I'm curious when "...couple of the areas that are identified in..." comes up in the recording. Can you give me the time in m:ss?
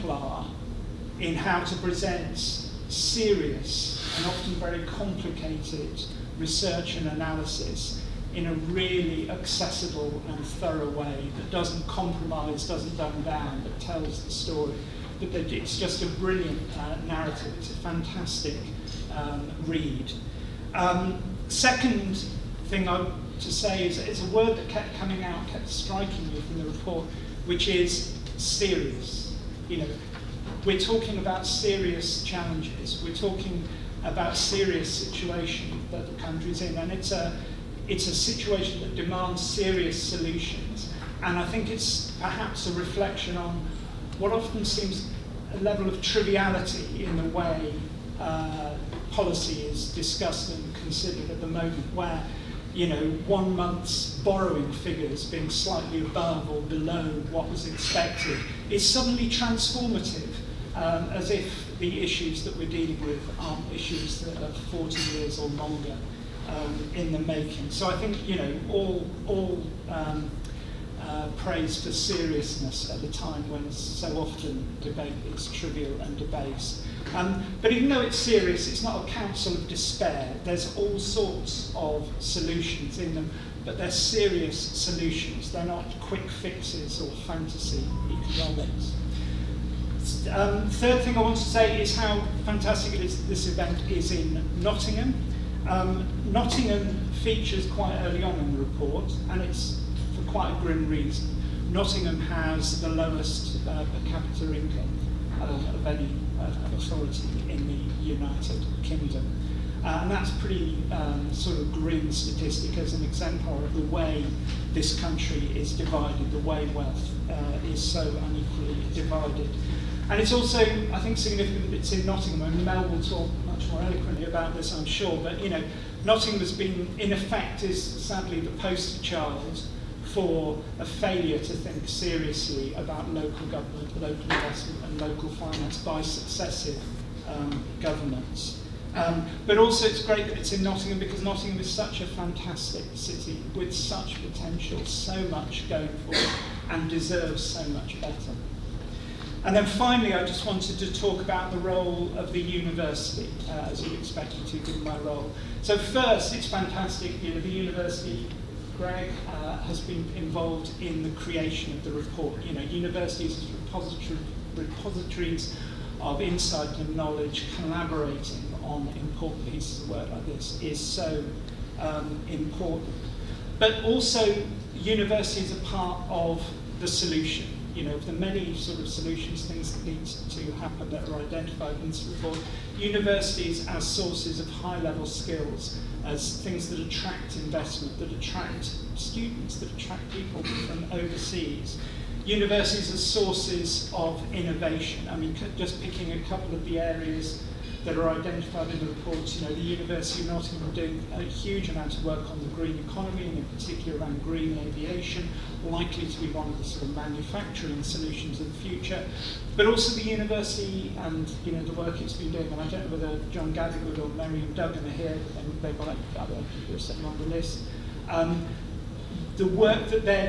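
3:16.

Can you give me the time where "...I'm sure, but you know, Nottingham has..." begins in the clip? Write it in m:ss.
2:04.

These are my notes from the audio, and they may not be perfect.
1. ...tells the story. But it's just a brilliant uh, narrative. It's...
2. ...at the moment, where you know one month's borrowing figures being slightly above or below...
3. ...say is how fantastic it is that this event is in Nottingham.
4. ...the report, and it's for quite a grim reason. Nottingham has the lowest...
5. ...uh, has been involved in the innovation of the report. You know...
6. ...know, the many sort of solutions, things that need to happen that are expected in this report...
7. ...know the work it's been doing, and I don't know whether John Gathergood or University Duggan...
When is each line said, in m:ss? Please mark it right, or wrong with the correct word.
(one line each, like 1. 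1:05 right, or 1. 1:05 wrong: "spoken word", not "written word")
1. 0:13 right
2. 0:51 right
3. 1:31 right
4. 1:38 right
5. 2:39 wrong: "creation", not "innovation"
6. 2:57 wrong: "identified", not "expected"
7. 3:31 wrong: "Miriam", not "University".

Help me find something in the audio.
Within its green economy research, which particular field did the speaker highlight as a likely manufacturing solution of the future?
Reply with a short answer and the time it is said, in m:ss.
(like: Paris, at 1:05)
Green aviation, at 3:24.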